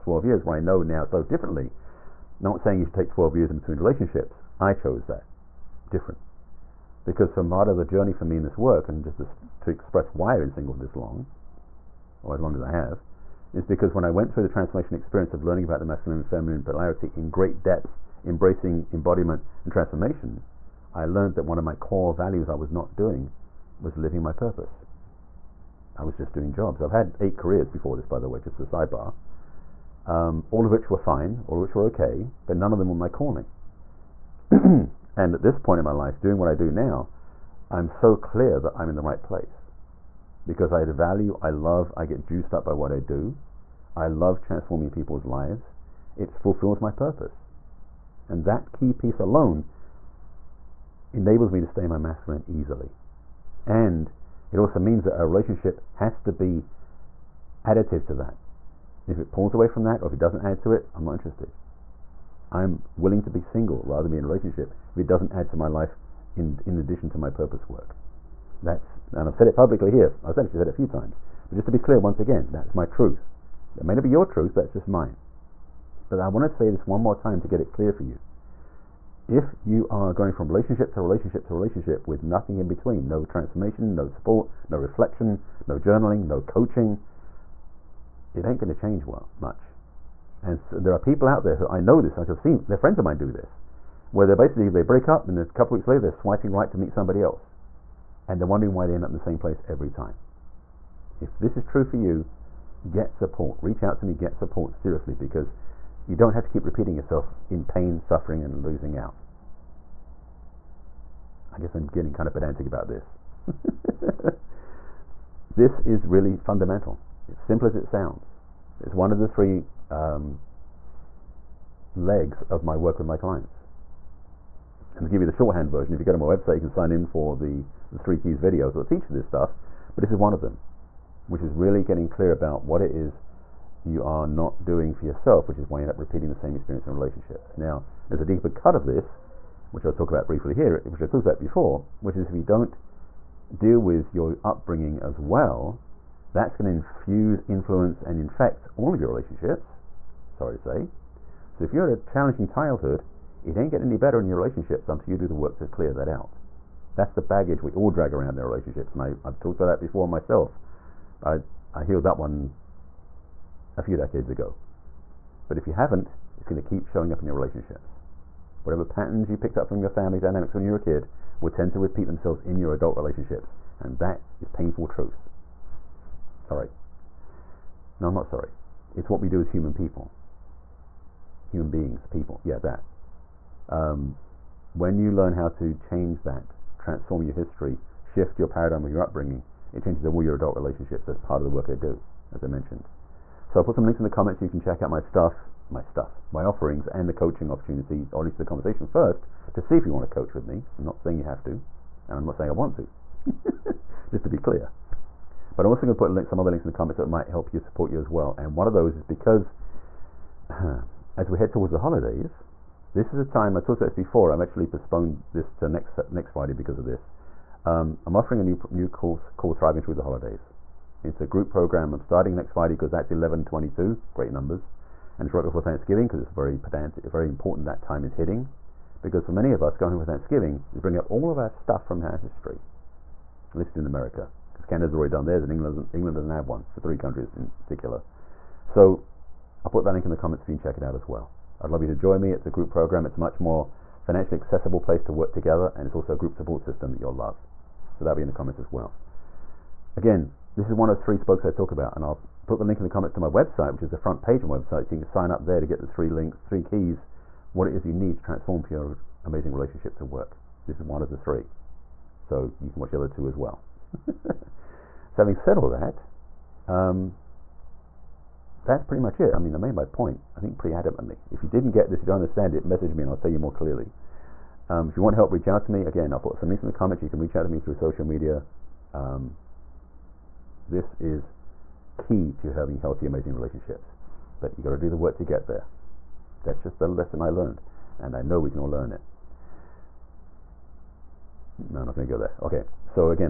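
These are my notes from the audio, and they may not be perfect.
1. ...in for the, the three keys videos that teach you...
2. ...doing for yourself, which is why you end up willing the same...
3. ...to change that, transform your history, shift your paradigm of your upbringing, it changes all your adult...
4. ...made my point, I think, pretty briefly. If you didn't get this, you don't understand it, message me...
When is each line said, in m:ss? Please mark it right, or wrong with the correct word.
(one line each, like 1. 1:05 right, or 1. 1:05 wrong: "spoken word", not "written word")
1. 2:06 right
2. 2:14 wrong: "repeating", not "willing"
3. 3:05 right
4. 4:29 wrong: "adamantly", not "briefly".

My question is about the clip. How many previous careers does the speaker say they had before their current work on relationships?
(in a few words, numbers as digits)
8.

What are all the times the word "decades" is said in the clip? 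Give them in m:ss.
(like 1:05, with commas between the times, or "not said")
2:43.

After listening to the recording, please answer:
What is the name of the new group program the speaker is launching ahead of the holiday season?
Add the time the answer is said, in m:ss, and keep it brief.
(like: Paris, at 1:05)
Thriving Through the Holidays, at 3:39.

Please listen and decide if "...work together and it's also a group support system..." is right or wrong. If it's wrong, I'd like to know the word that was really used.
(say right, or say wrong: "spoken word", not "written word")
right.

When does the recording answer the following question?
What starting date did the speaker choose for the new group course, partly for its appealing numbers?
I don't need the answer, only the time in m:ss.
3:43.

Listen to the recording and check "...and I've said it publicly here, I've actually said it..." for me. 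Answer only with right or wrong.
right.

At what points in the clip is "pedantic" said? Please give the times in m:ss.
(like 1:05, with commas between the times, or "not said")
1:52, 3:46.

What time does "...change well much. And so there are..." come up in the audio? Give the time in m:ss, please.
1:28.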